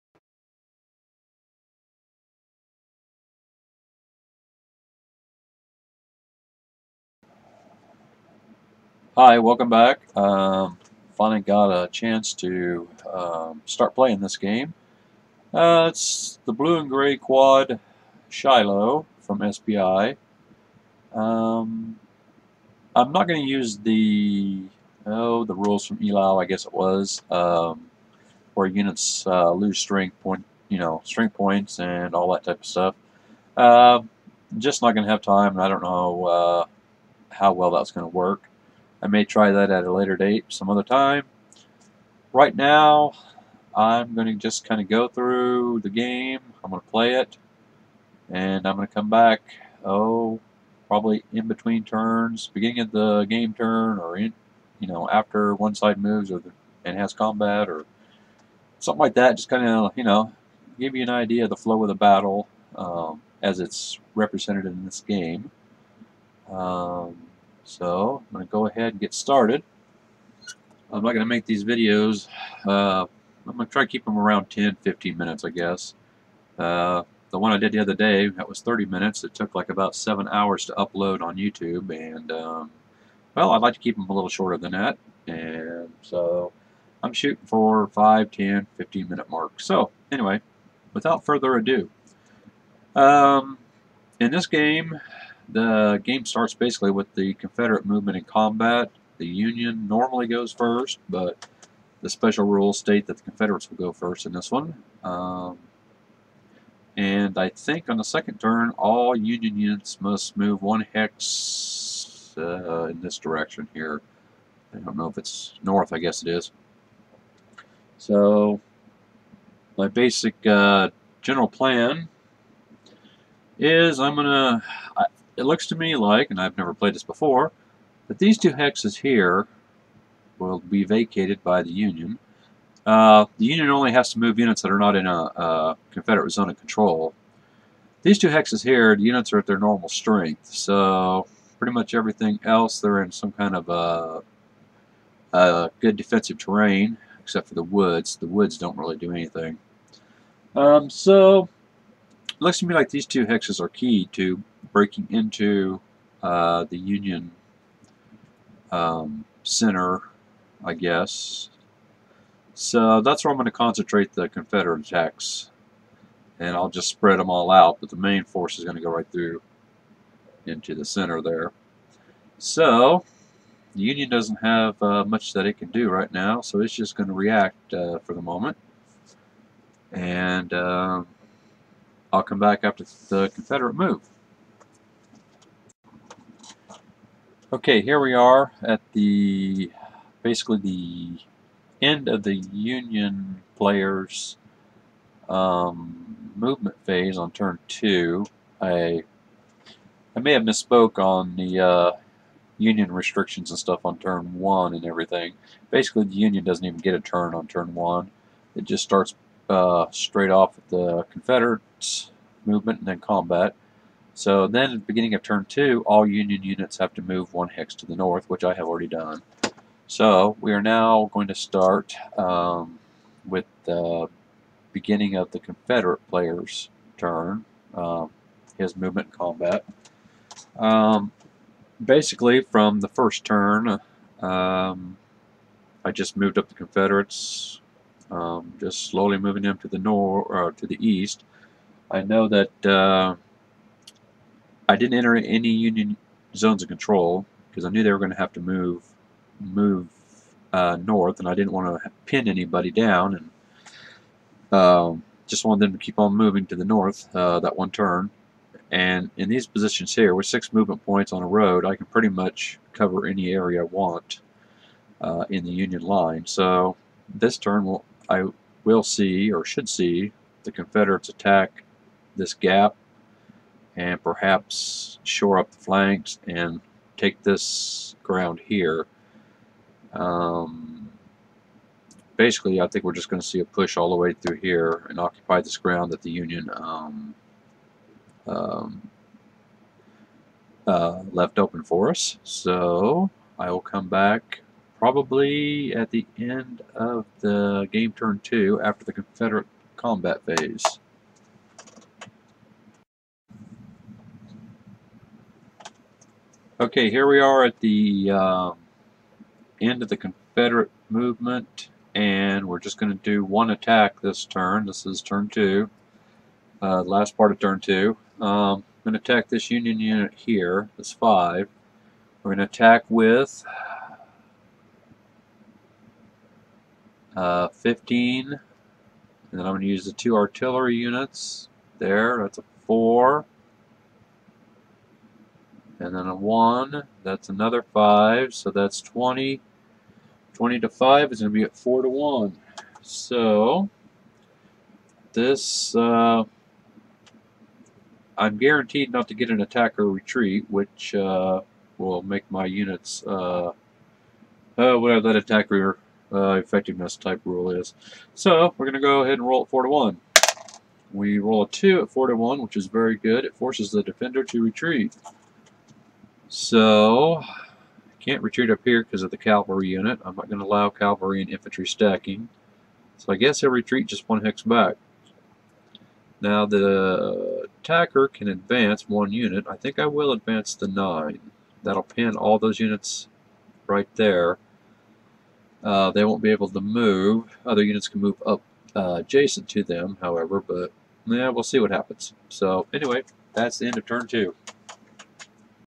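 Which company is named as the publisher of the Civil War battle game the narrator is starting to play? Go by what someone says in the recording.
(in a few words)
SPI.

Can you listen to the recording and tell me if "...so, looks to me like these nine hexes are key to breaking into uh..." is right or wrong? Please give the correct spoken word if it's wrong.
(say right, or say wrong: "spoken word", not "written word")
wrong: "two", not "nine".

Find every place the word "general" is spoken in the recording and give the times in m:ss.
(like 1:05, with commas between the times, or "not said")
2:01.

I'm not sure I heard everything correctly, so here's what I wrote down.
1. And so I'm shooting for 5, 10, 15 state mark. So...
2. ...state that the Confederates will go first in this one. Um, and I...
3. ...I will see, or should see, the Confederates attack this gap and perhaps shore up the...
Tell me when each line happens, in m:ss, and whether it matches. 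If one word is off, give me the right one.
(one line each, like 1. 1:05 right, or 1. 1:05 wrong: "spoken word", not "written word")
1. 1:25 wrong: "minute", not "state"
2. 1:42 right
3. 4:28 right.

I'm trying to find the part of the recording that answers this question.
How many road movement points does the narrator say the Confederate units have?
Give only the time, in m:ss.
4:20.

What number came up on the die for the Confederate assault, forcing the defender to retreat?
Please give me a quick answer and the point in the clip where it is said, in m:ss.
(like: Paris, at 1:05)
2, at 6:01.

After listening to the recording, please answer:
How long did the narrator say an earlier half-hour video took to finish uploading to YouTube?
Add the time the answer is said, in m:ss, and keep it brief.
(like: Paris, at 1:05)
about 7 hours, at 1:19.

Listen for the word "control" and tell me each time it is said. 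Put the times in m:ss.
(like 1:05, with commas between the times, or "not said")
2:16, 4:06.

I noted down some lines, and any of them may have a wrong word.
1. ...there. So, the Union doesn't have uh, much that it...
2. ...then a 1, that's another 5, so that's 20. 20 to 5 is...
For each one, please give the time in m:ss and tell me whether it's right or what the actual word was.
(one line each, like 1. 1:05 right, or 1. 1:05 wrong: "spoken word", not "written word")
1. 2:51 right
2. 5:35 right.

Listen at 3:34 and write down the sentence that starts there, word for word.
So then, beginning of turn 2, all Union units have to move one hex to the north, which I have already done.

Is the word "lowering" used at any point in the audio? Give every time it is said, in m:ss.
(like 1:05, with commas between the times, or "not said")
not said.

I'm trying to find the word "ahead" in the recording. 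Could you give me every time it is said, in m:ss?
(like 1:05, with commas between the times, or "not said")
1:08, 5:59.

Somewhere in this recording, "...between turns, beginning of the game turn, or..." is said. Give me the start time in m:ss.
0:51.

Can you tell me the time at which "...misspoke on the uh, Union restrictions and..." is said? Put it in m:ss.
3:20.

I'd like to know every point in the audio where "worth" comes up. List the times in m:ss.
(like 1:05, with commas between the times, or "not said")
not said.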